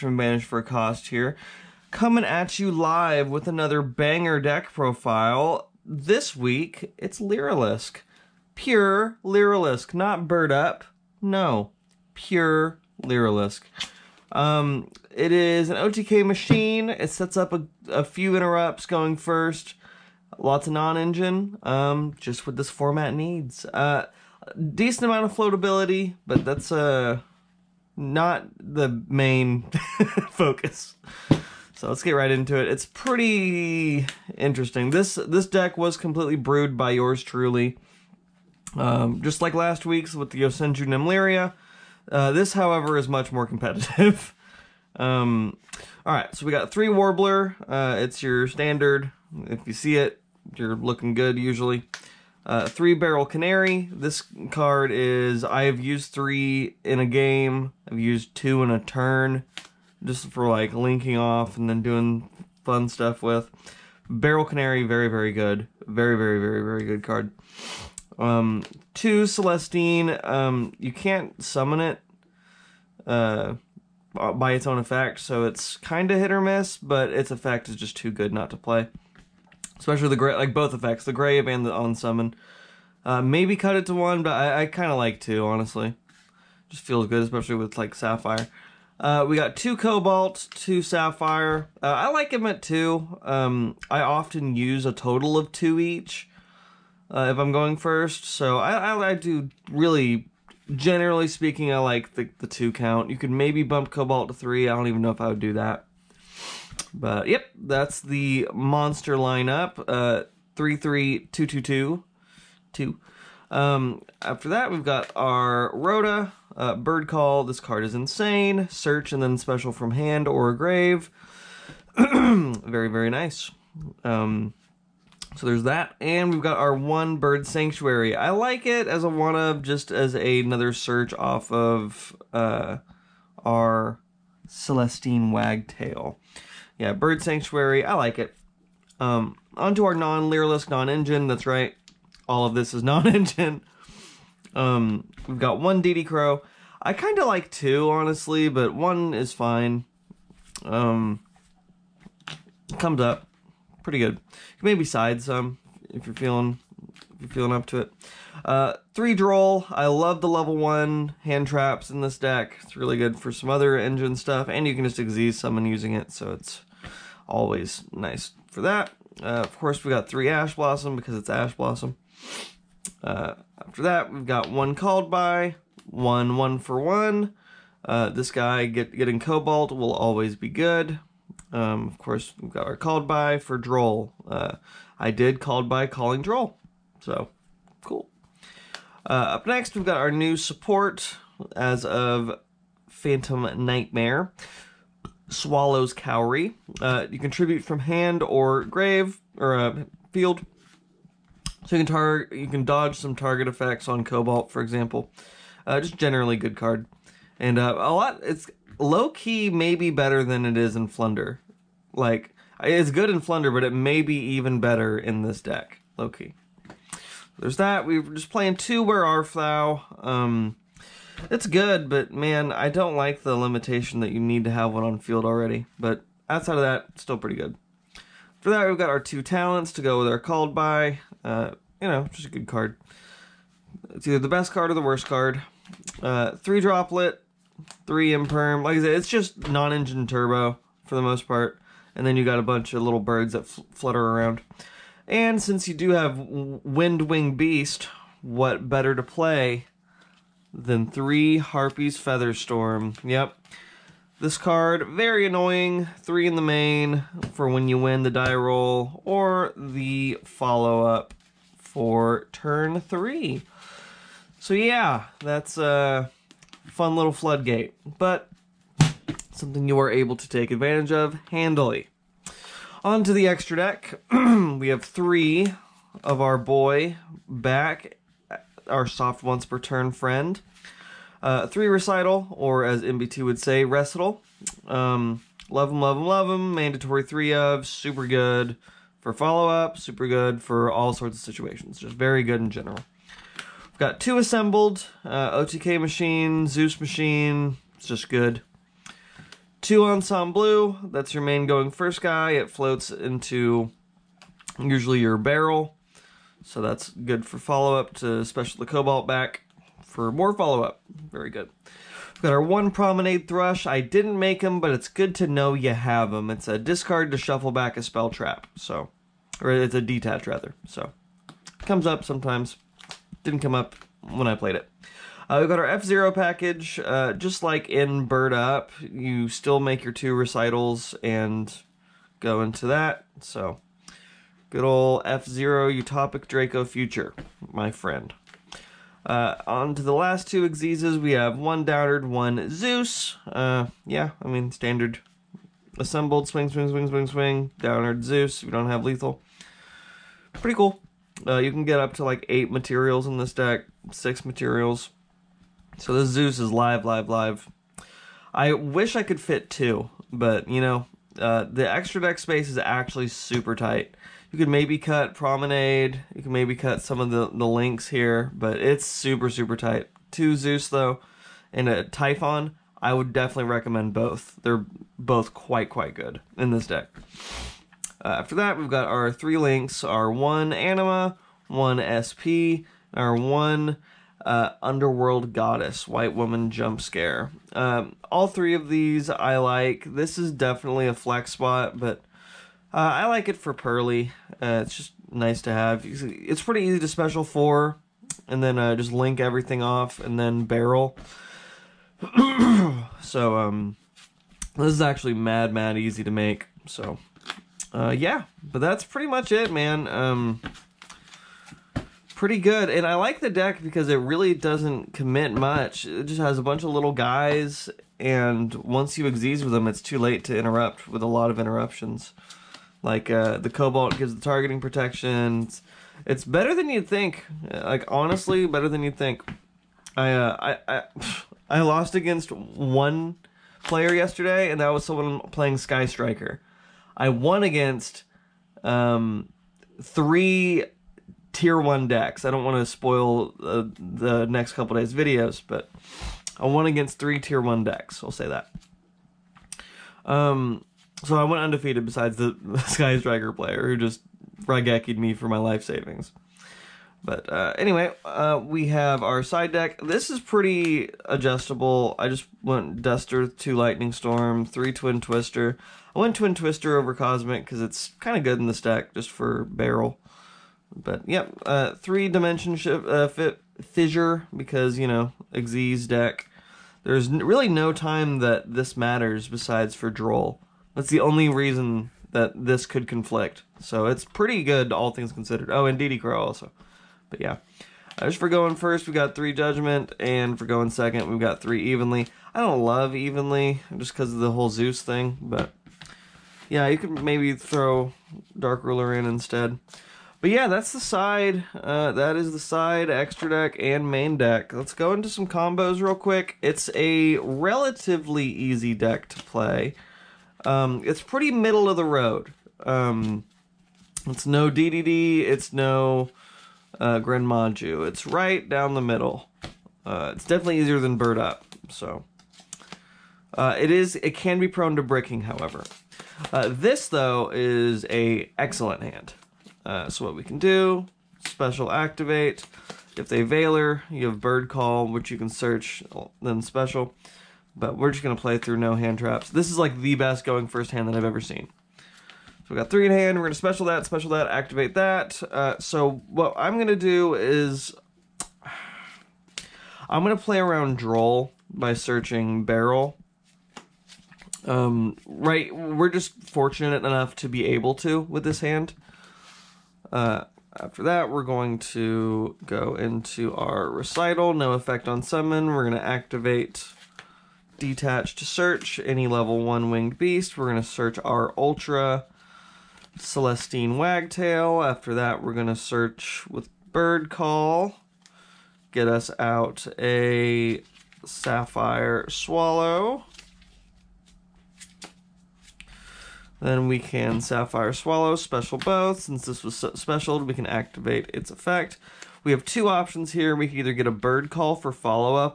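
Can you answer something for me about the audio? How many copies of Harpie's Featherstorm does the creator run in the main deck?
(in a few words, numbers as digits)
3.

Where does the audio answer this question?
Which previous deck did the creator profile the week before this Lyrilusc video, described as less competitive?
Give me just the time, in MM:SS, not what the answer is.
00:40.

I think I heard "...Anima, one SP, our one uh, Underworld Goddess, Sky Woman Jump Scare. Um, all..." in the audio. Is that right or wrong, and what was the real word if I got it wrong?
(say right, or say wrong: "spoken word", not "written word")
wrong: "White", not "Sky".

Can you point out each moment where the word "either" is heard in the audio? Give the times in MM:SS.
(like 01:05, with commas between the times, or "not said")
03:54, 09:53.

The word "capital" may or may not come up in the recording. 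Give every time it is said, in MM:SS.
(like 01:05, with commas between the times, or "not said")
not said.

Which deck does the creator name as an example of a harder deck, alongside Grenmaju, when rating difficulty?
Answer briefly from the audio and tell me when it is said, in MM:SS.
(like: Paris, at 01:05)
DDD, at 08:34.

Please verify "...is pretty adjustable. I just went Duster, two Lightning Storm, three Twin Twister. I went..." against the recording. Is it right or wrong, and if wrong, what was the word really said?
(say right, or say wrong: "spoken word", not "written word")
right.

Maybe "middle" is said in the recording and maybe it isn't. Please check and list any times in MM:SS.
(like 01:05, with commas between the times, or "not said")
08:31, 08:38.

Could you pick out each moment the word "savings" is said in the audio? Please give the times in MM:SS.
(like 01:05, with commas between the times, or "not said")
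07:35.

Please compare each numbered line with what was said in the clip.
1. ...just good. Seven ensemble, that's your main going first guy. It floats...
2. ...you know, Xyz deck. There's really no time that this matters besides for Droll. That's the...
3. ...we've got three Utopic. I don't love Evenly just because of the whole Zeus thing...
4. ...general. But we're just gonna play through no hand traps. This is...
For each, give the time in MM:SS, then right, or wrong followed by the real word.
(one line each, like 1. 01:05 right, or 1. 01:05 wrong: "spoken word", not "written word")
1. 04:57 wrong: "Two", not "Seven"
2. 07:54 right
3. 08:11 wrong: "Evenly", not "Utopic"
4. 08:56 wrong: "special", not "general".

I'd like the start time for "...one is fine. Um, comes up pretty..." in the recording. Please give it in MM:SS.
02:28.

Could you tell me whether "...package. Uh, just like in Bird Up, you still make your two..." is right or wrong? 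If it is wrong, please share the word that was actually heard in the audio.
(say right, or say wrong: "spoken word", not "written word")
right.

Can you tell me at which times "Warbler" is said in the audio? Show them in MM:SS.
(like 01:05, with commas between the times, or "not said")
00:46.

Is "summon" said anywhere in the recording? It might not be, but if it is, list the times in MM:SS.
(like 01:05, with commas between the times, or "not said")
01:11, 01:21, 09:25.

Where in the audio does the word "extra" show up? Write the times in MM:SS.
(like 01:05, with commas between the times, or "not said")
04:33, 06:01, 08:22.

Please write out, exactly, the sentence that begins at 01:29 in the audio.
Uh, we got two cobalt, two sapphire.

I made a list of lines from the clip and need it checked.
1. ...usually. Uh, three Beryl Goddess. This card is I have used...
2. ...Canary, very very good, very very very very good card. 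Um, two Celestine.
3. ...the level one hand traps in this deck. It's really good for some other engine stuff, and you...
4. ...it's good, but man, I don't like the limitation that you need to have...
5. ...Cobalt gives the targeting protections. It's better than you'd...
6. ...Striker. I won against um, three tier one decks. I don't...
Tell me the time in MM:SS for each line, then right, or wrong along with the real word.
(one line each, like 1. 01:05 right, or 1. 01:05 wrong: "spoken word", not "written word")
1. 00:51 wrong: "Canary", not "Goddess"
2. 01:04 right
3. 02:40 right
4. 03:41 right
5. 07:03 right
6. 07:15 right.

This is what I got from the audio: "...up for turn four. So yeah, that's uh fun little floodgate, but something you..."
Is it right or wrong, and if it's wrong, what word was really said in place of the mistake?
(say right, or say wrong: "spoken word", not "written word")
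wrong: "three", not "four".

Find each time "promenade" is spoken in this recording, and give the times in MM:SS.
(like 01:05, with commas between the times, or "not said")
05:12, 06:05.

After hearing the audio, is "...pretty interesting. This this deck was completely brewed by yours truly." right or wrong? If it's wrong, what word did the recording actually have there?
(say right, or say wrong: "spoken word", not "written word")
right.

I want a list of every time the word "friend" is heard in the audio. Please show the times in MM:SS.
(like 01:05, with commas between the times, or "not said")
04:39, 05:37.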